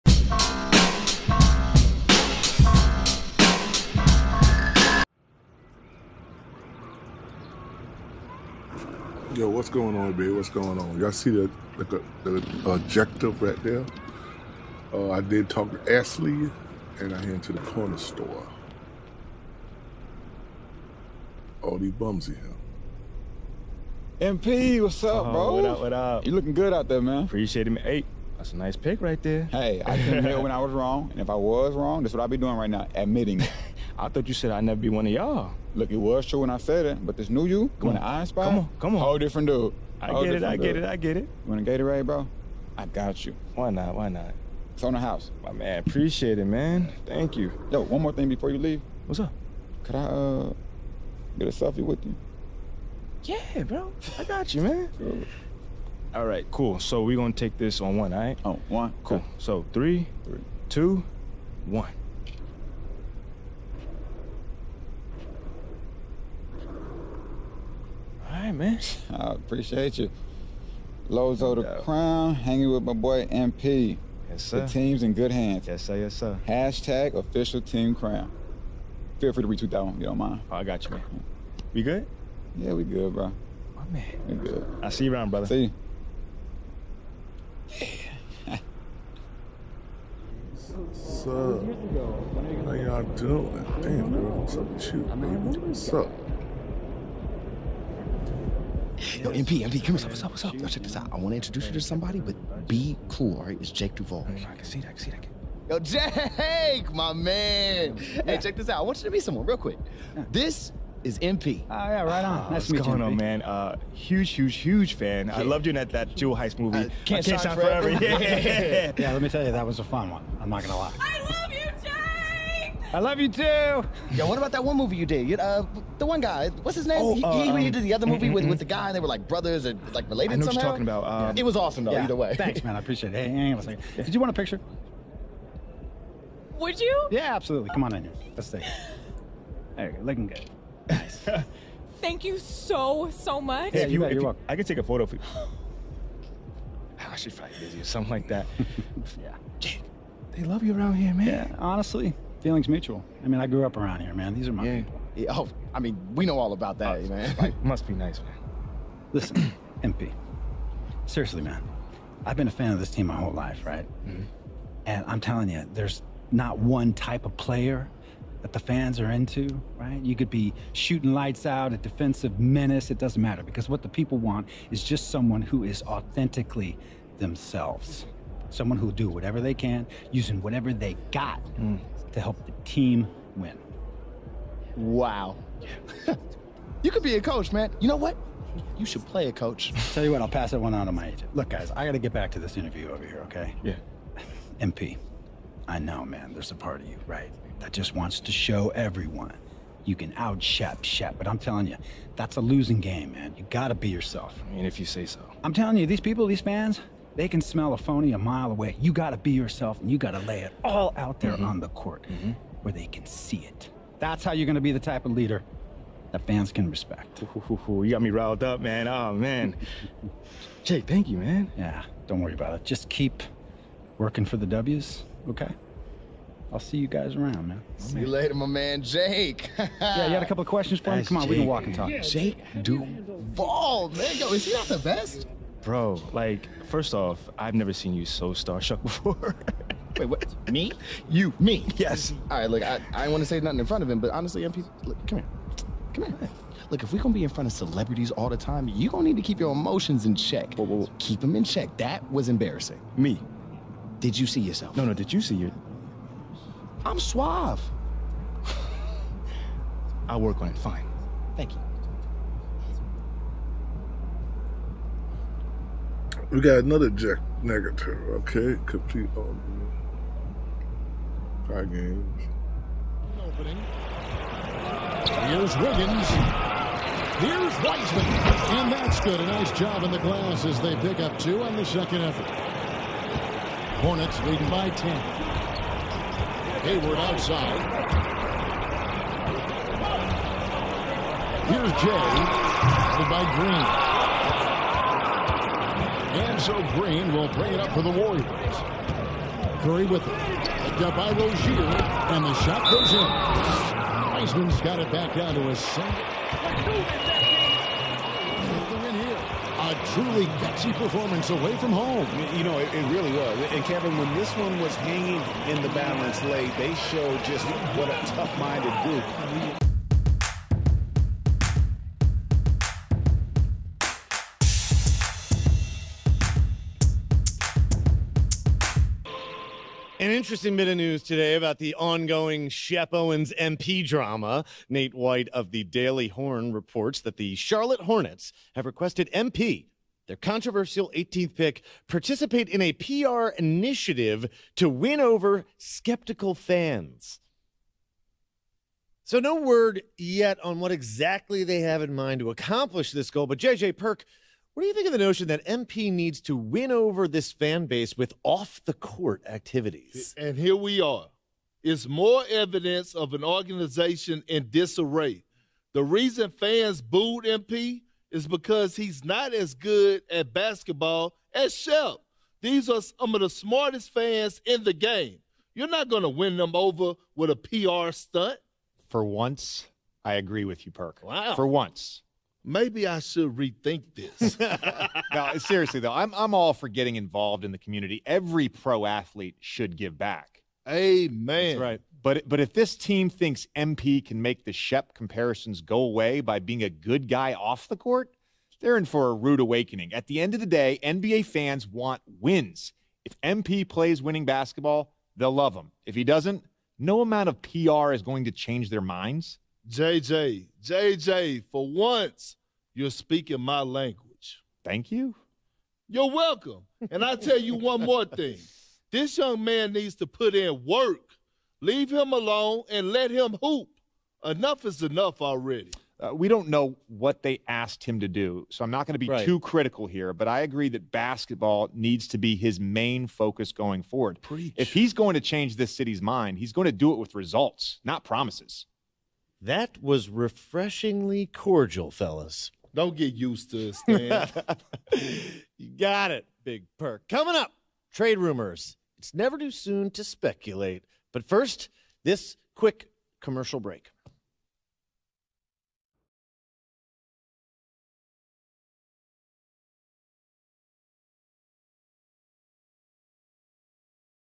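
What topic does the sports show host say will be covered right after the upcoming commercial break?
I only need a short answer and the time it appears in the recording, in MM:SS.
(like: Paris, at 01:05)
Trade rumors, at 07:27.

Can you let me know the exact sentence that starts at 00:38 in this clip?
I inspire, come on, come on, whole different dude.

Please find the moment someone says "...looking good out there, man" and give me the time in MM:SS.
00:26.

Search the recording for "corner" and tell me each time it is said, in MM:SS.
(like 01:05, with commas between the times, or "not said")
00:17.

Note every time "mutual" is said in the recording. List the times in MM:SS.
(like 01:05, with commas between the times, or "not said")
02:32.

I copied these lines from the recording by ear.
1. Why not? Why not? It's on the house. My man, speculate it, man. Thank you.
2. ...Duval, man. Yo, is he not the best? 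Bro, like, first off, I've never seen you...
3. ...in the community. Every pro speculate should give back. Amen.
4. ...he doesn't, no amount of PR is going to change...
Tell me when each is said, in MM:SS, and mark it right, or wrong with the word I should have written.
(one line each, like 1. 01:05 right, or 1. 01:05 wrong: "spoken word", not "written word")
1. 00:43 wrong: "appreciate", not "speculate"
2. 03:52 right
3. 06:27 wrong: "athlete", not "speculate"
4. 06:45 right.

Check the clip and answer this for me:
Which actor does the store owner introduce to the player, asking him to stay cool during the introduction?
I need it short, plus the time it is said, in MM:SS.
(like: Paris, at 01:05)
Jake Duvall, at 01:43.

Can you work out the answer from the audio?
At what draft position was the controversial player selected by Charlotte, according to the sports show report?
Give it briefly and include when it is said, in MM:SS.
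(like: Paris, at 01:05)
18th pick, at 05:40.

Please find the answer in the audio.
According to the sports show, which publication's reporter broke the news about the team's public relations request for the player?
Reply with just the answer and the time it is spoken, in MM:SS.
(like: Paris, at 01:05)
The Daily Horn, at 05:35.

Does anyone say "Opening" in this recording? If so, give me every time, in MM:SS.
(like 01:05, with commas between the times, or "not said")
04:33.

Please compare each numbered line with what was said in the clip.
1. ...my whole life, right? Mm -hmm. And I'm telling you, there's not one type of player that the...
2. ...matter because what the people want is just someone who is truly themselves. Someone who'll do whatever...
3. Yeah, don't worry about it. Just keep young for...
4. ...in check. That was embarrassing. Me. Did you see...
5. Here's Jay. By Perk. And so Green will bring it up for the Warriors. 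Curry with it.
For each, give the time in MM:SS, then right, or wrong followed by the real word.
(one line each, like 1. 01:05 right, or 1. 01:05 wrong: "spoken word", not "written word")
1. 02:43 right
2. 02:53 wrong: "authentically", not "truly"
3. 03:41 wrong: "working", not "young"
4. 04:11 right
5. 04:51 wrong: "Green", not "Perk".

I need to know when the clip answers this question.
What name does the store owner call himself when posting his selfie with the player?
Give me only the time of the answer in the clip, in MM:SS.
01:11.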